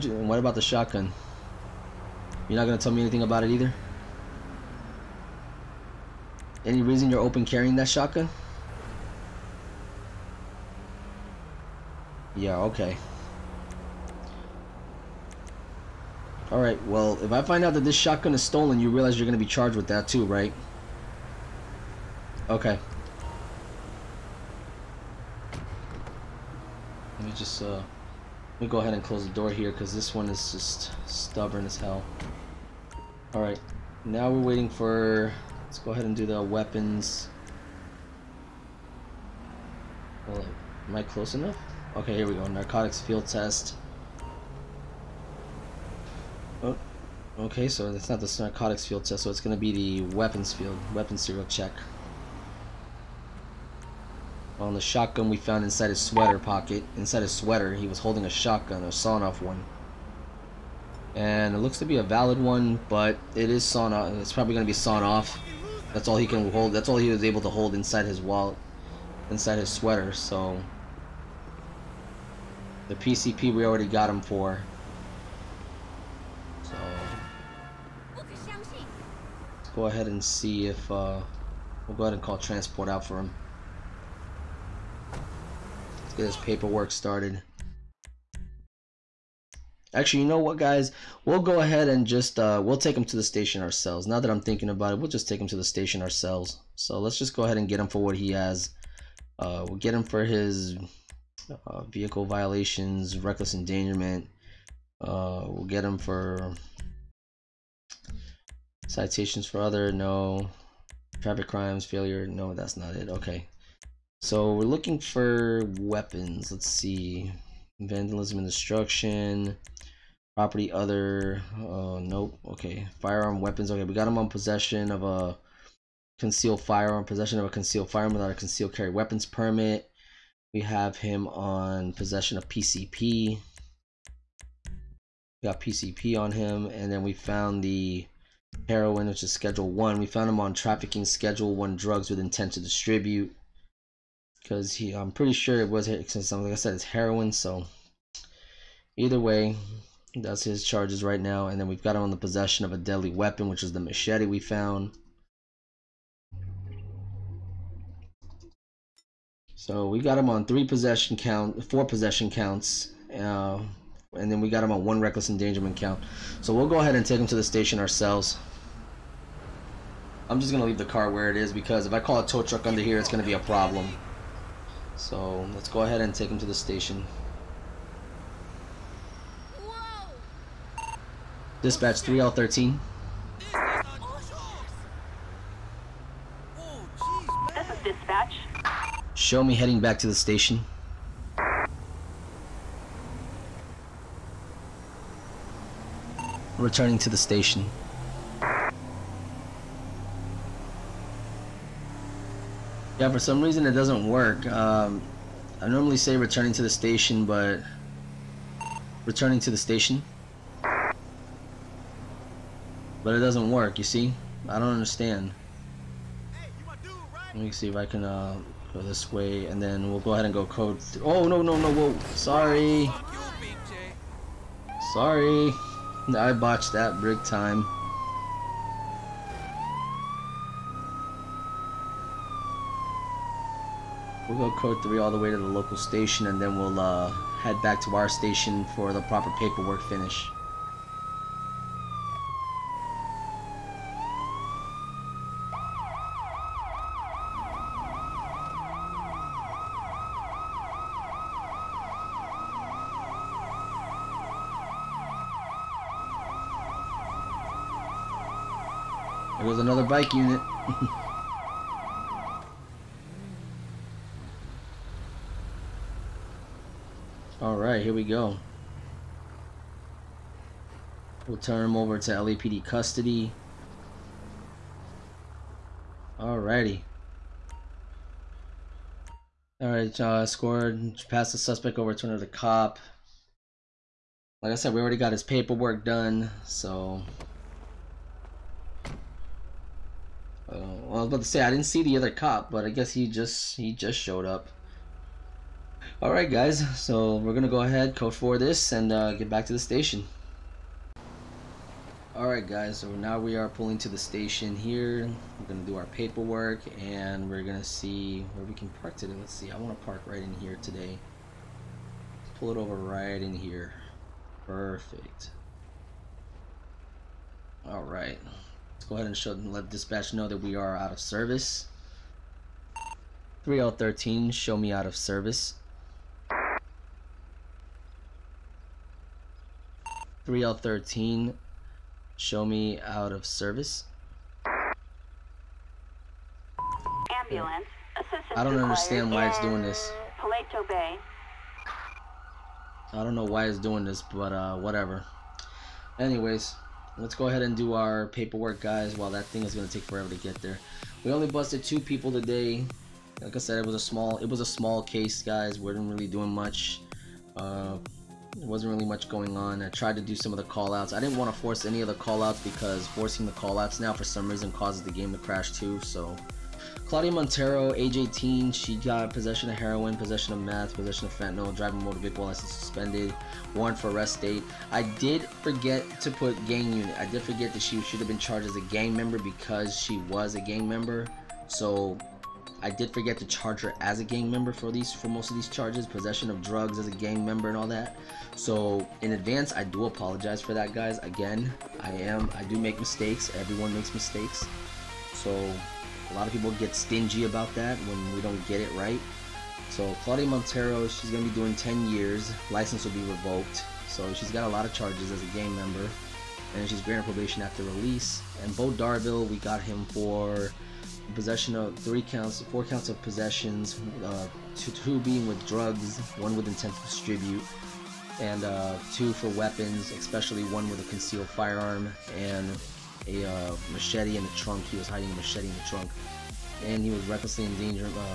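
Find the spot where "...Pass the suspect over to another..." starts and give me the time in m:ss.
4:41.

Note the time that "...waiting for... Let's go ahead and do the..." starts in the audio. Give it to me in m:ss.
0:34.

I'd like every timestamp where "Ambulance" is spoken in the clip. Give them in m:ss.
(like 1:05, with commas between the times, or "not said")
5:37.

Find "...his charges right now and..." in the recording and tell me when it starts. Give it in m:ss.
2:30.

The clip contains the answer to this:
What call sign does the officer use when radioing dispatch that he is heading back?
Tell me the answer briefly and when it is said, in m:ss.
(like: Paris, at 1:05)
3L13, at 3:01.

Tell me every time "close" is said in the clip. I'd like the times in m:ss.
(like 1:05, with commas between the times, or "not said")
0:29, 0:41.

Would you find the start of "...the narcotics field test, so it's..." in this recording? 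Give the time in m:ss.
0:48.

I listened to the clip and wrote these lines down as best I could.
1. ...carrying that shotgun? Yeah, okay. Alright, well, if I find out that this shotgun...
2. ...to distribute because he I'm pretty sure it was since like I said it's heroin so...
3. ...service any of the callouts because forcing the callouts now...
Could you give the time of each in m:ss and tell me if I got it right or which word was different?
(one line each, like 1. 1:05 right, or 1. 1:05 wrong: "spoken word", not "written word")
1. 0:07 right
2. 2:22 right
3. 6:01 wrong: "force", not "service".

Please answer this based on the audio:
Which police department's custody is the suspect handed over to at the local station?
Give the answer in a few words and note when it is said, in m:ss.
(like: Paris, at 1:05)
LAPD, at 4:32.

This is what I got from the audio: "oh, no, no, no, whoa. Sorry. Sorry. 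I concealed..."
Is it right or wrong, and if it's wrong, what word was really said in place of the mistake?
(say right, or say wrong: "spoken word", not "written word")
wrong: "botched", not "concealed".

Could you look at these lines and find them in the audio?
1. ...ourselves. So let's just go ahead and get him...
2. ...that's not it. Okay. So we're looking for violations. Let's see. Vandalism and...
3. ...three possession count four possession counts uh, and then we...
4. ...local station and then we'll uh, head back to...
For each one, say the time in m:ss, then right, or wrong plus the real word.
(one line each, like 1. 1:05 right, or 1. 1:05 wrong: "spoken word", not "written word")
1. 1:36 right
2. 1:52 wrong: "weapons", not "violations"
3. 2:40 right
4. 3:55 right.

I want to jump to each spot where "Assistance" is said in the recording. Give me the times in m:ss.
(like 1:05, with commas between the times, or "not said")
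5:37.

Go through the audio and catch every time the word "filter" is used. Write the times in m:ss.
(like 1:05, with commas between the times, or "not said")
not said.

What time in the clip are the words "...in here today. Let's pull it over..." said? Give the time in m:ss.
5:10.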